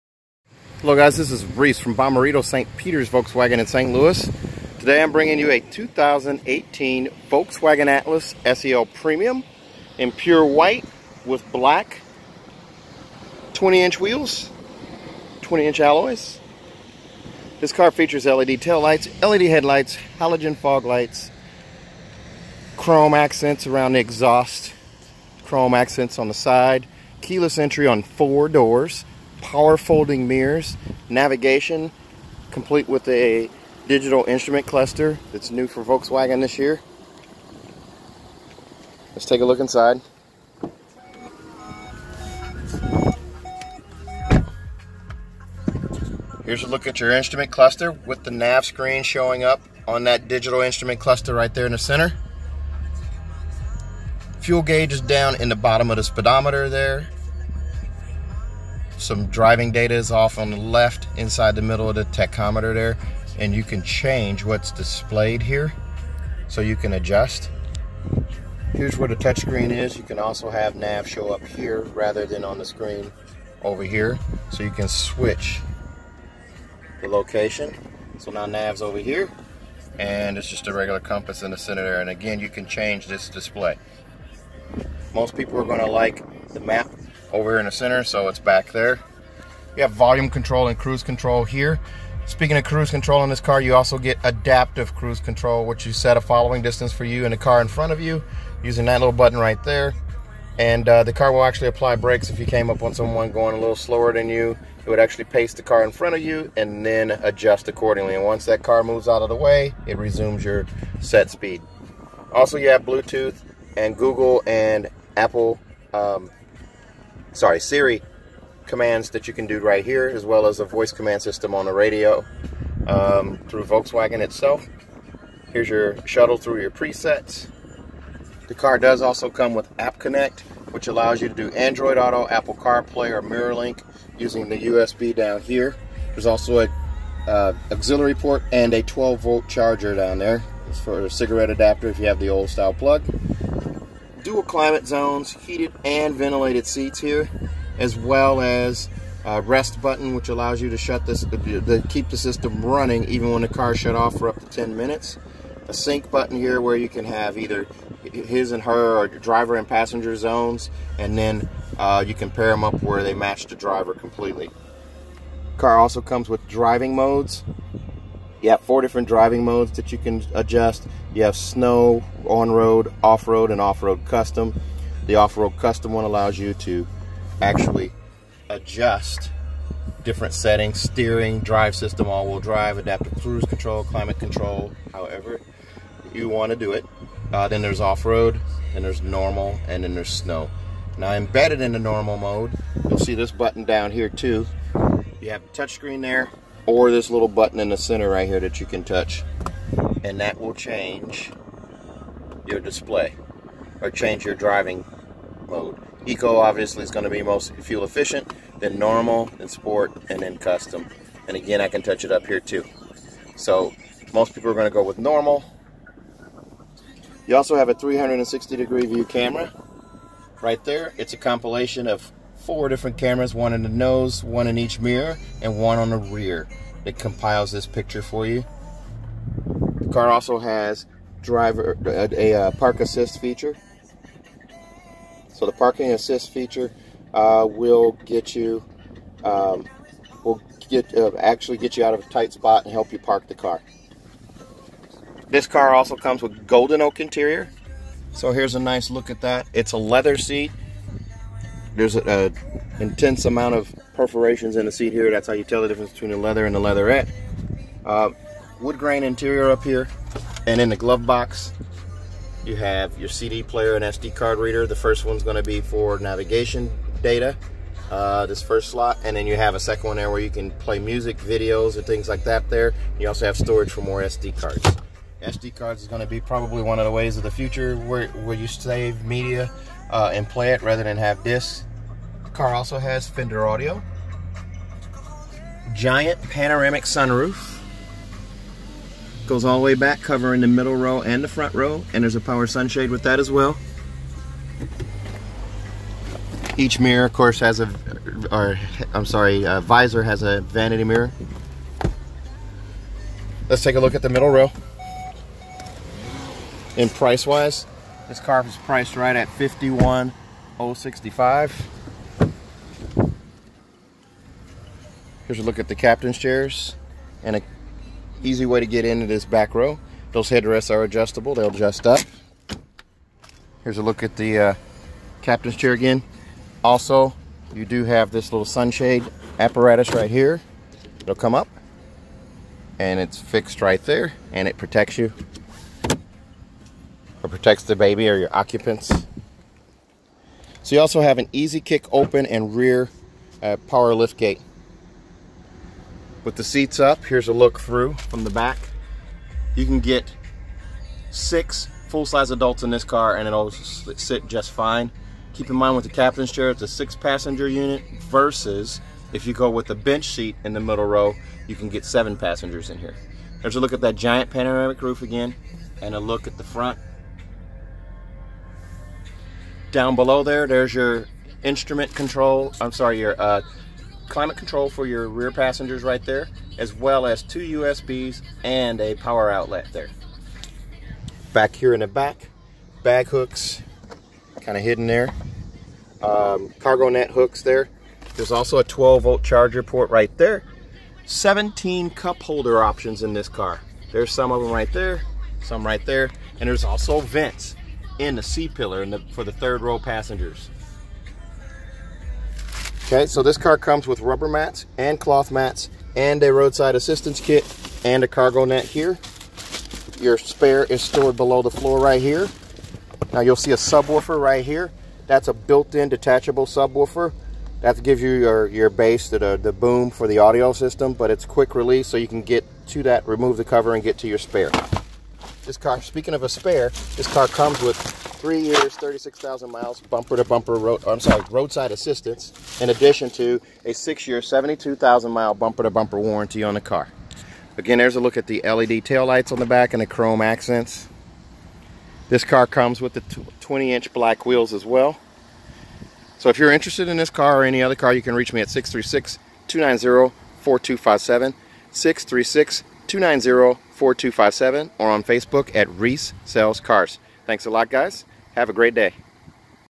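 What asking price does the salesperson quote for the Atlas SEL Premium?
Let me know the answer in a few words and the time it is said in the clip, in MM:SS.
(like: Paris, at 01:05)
$51,065, at 05:09.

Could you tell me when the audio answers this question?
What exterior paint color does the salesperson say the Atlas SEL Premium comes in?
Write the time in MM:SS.
00:10.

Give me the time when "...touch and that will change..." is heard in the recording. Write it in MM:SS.
03:18.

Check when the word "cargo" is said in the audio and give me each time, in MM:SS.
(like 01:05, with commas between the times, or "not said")
06:26, 06:48.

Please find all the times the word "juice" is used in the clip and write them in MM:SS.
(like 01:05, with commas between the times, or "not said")
not said.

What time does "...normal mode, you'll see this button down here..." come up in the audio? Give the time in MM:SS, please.
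03:11.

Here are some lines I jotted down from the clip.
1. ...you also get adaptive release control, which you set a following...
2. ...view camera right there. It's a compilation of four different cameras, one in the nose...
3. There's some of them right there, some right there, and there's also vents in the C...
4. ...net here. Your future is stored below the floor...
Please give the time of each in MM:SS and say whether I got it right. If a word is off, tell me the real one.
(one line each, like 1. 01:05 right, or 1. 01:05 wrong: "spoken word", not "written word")
1. 01:33 wrong: "cruise", not "release"
2. 03:38 right
3. 06:33 right
4. 06:48 wrong: "spare", not "future".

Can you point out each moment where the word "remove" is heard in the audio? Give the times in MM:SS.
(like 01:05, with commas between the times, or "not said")
07:03.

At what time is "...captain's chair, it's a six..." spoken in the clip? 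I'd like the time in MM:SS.
05:55.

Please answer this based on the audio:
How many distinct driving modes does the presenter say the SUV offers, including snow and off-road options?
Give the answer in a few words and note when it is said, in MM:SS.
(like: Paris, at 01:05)
4, at 02:48.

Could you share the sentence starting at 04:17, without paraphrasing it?
Uh, wood grain interior up here.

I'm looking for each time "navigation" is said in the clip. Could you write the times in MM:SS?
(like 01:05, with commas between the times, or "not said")
00:31, 04:25.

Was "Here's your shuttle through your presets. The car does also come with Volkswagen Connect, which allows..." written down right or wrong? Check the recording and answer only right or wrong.
wrong.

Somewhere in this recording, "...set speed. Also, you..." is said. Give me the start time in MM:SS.
01:50.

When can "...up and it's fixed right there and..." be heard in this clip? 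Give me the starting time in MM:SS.
05:31.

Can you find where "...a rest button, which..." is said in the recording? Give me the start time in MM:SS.
02:29.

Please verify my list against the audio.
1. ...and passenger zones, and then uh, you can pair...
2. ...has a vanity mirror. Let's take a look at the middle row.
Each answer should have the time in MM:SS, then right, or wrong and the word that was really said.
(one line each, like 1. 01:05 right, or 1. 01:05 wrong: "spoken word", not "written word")
1. 02:39 right
2. 05:00 right.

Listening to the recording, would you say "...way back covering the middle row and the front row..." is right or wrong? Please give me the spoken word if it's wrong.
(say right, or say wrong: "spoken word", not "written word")
right.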